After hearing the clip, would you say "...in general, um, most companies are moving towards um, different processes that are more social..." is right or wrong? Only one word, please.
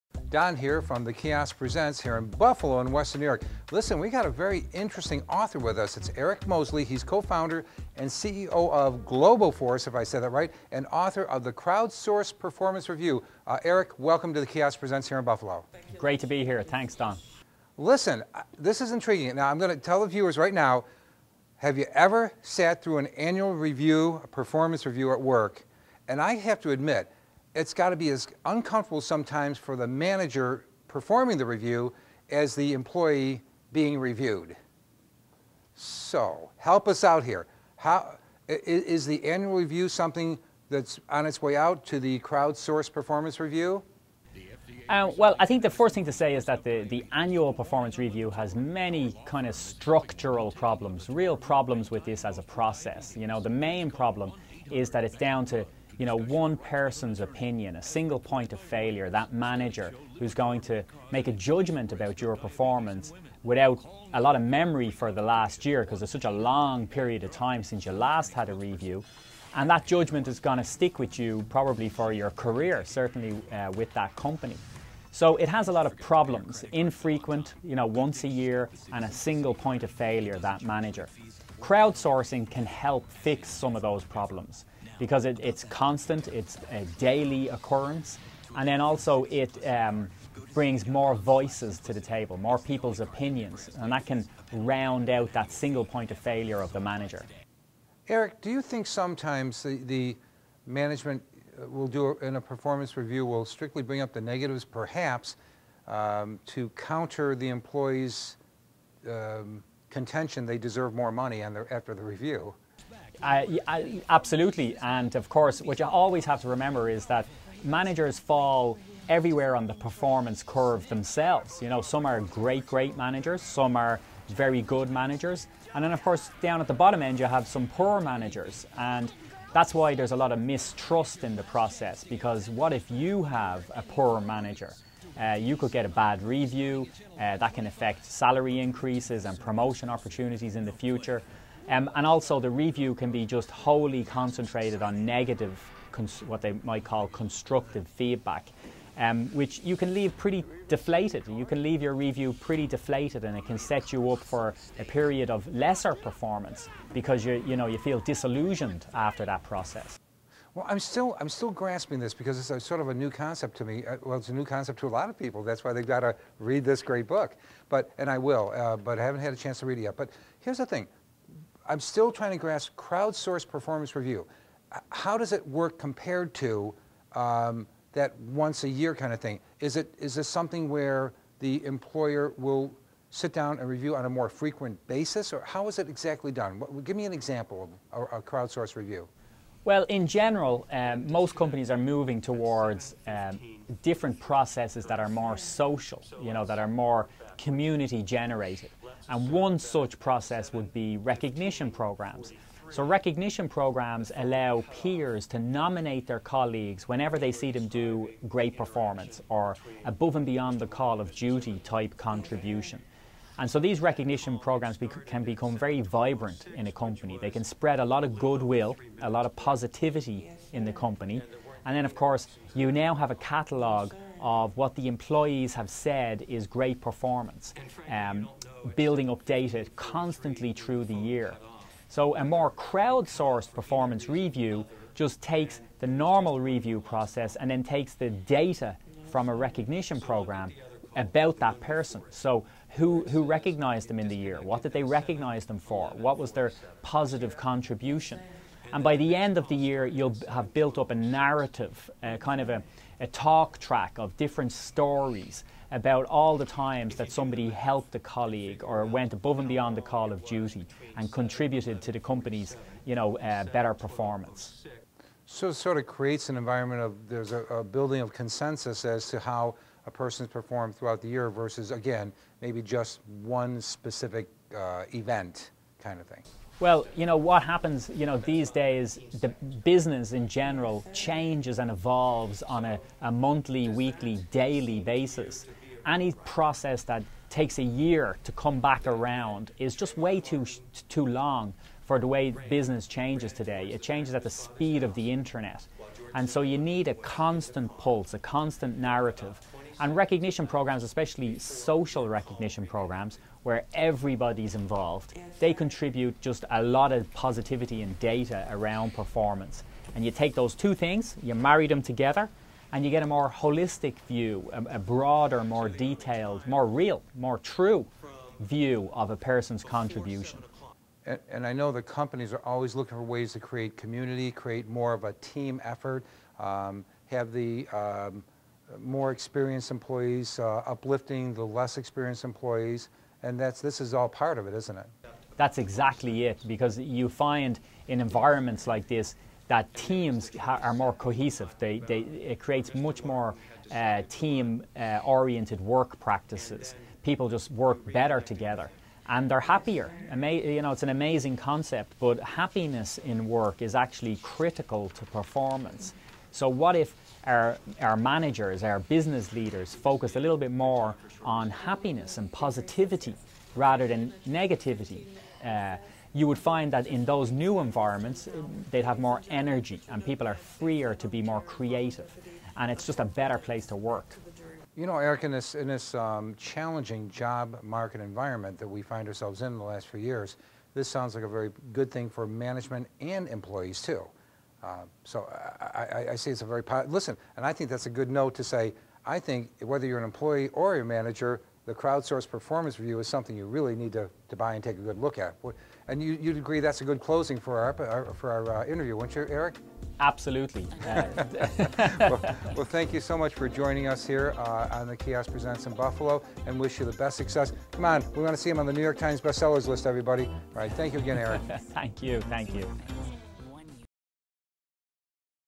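right.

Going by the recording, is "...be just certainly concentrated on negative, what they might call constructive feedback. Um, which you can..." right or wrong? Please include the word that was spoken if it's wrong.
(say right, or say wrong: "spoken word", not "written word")
wrong: "wholly", not "certainly".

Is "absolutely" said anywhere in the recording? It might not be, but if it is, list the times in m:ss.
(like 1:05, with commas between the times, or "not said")
1:54, 6:39.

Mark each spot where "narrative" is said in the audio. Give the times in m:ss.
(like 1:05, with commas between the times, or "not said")
4:10, 4:58.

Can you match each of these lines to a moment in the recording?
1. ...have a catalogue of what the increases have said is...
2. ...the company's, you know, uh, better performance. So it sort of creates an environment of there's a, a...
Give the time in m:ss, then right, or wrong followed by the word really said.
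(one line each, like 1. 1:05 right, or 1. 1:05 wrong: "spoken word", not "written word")
1. 3:42 wrong: "employees", not "increases"
2. 4:21 right.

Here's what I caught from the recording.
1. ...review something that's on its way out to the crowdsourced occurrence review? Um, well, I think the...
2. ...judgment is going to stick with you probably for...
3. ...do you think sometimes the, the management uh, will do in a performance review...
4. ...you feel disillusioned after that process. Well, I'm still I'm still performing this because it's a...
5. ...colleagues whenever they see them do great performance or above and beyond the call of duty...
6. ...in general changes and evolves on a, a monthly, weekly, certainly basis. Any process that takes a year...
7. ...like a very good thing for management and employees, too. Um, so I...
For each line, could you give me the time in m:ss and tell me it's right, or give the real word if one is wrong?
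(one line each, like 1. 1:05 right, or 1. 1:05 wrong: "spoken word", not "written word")
1. 0:39 wrong: "performance", not "occurrence"
2. 1:09 right
3. 1:38 right
4. 2:37 wrong: "grasping", not "performing"
5. 3:26 right
6. 4:40 wrong: "daily", not "certainly"
7. 6:21 right.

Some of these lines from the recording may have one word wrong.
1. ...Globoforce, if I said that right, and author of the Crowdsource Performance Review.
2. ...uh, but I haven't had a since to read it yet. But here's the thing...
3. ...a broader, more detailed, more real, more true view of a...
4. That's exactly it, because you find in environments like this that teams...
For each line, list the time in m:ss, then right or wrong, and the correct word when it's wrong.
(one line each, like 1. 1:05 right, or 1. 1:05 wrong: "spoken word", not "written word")
1. 0:08 right
2. 2:48 wrong: "chance", not "since"
3. 5:14 right
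4. 5:35 right.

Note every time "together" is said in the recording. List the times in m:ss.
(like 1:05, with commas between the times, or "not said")
5:11, 5:48.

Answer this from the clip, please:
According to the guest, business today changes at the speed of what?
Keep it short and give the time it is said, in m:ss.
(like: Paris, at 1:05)
the internet, at 4:54.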